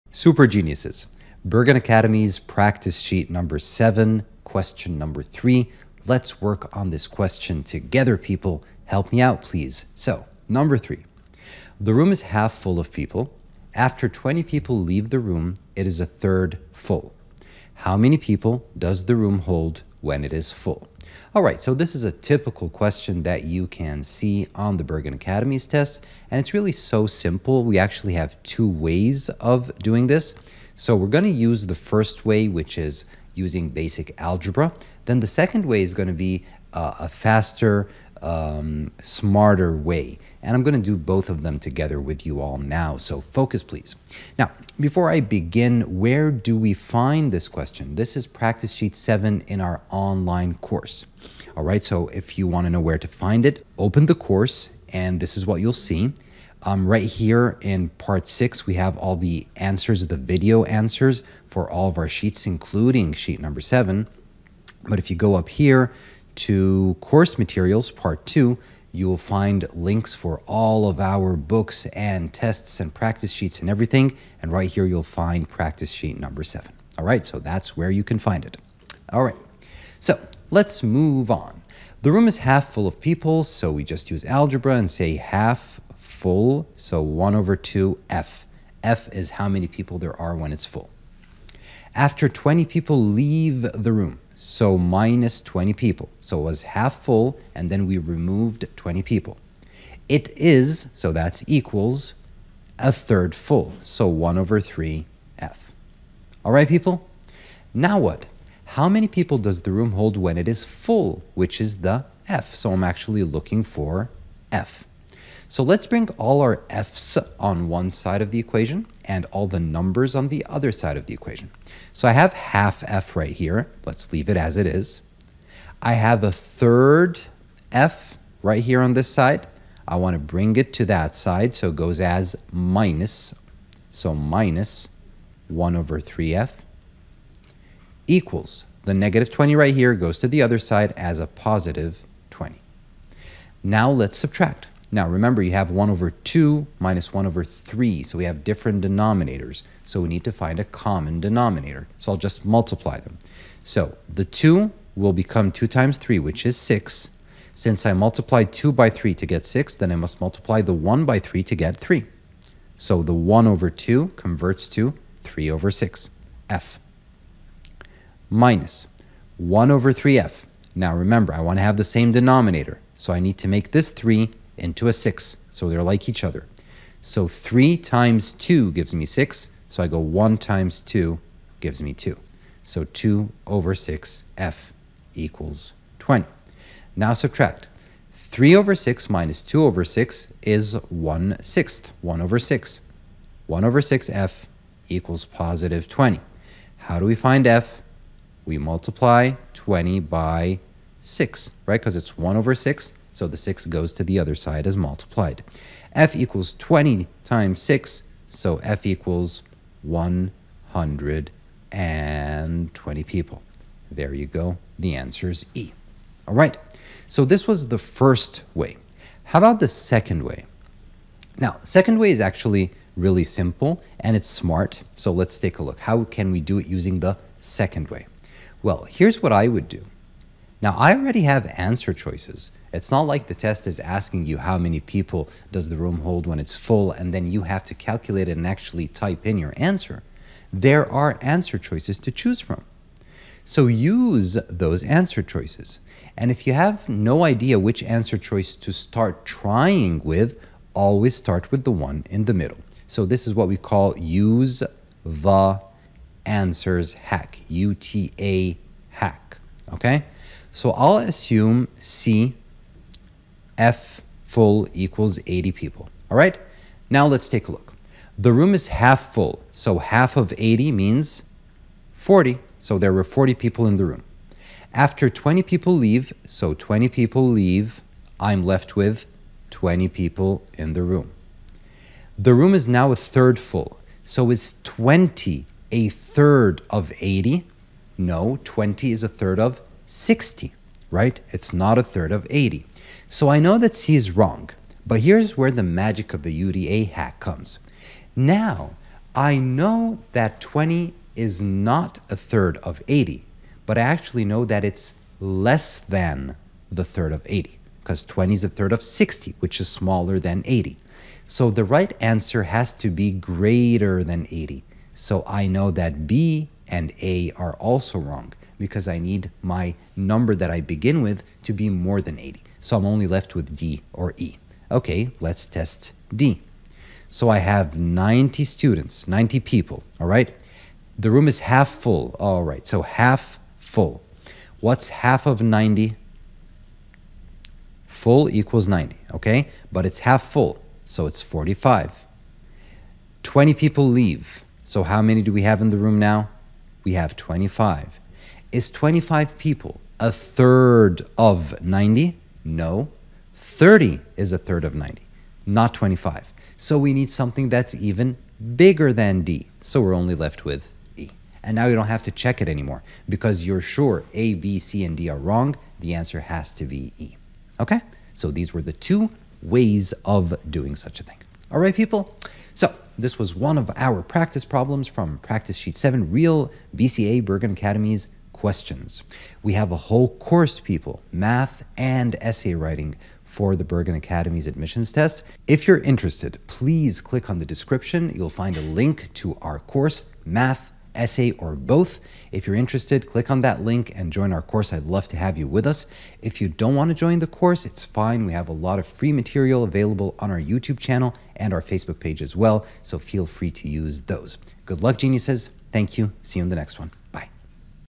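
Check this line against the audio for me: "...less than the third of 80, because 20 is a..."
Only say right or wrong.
right.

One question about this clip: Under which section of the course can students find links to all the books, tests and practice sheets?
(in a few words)
Course Materials Part 2.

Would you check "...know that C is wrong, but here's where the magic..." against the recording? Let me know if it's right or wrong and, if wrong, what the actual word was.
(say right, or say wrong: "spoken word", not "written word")
right.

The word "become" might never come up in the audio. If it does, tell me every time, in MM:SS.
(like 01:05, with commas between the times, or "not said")
02:35.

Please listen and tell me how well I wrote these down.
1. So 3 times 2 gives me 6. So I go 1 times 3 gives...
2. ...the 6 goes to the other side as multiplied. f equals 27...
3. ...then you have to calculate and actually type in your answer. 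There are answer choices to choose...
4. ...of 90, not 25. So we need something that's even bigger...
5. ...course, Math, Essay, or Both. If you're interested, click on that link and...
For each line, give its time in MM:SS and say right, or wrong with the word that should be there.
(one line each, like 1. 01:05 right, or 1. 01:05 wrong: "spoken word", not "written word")
1. 02:57 wrong: "2", not "3"
2. 03:23 wrong: "20", not "27"
3. 03:57 right
4. 05:54 right
5. 06:29 right.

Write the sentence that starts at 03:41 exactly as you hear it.
Now, second way is actually really simple and it's smart.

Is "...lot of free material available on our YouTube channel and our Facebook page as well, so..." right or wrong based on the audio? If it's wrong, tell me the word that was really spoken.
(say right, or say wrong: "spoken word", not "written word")
right.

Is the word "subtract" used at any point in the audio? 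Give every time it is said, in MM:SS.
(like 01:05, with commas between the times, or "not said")
02:24, 03:07.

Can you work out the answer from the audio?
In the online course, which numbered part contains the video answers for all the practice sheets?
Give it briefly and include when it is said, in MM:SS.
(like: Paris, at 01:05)
Part 6, at 00:57.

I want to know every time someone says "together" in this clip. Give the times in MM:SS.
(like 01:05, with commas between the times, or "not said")
00:07, 00:41.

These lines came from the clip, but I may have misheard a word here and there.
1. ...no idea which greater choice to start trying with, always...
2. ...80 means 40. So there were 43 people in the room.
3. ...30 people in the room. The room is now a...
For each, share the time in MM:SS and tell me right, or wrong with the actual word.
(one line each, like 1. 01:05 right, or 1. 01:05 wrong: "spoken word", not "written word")
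1. 04:06 wrong: "answer", not "greater"
2. 04:30 wrong: "40", not "43"
3. 04:39 wrong: "20", not "30".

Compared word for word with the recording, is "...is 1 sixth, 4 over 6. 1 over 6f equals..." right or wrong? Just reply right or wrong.
wrong.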